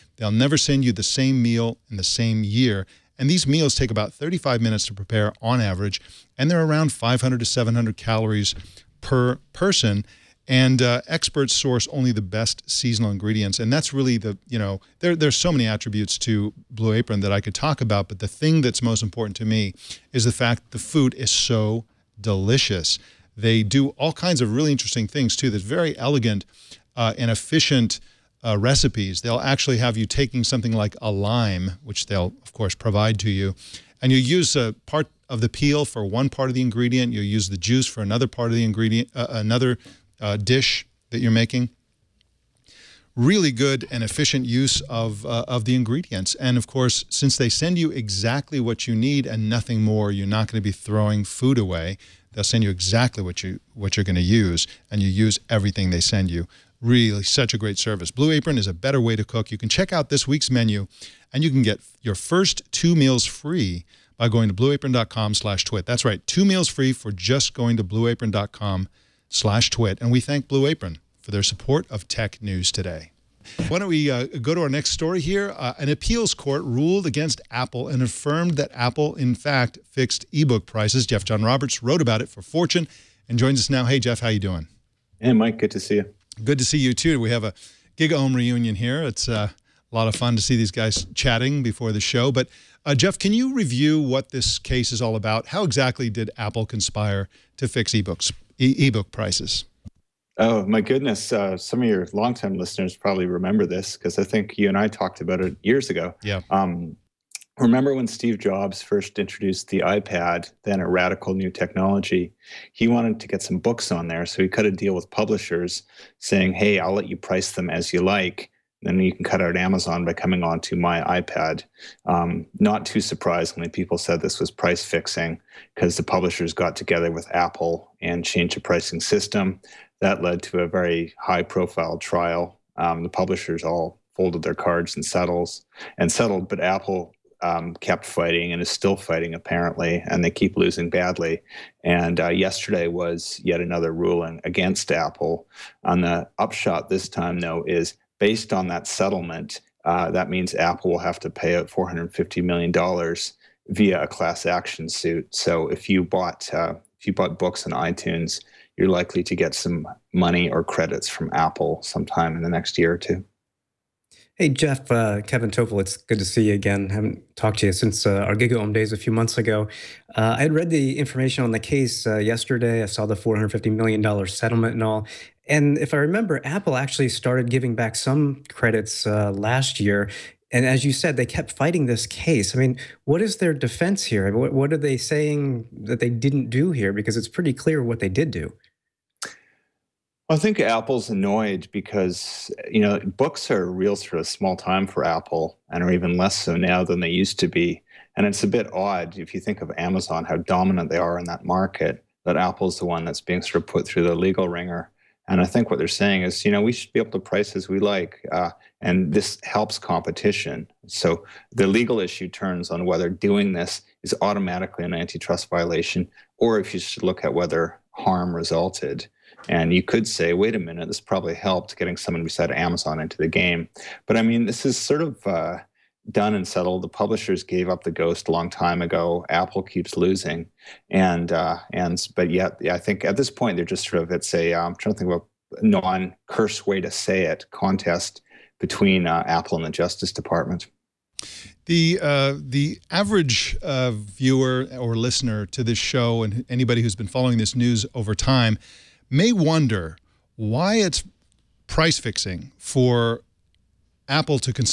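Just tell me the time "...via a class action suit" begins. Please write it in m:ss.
2:33.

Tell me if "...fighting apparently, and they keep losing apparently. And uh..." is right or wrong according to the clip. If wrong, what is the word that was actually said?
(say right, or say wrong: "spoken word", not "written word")
wrong: "badly", not "apparently".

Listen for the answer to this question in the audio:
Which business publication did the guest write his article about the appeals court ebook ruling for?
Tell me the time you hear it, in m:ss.
1:22.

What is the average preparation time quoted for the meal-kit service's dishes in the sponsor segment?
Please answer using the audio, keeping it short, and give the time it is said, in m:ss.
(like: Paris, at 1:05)
35 minutes, at 0:04.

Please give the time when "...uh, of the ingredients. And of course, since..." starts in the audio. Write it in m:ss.
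0:45.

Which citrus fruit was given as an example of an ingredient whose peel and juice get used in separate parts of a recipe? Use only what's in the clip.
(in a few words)
Lime.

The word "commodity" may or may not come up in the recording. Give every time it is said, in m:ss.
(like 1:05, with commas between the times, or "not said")
not said.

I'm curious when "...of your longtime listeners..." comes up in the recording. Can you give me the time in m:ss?
1:41.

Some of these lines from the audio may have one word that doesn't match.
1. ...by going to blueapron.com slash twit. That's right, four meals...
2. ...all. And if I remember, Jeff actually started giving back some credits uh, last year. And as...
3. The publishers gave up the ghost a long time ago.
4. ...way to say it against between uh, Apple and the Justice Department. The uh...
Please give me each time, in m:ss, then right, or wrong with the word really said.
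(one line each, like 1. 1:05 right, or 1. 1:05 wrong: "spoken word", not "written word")
1. 1:04 wrong: "two", not "four"
2. 2:54 wrong: "Apple", not "Jeff"
3. 3:46 right
4. 3:56 wrong: "contest", not "against".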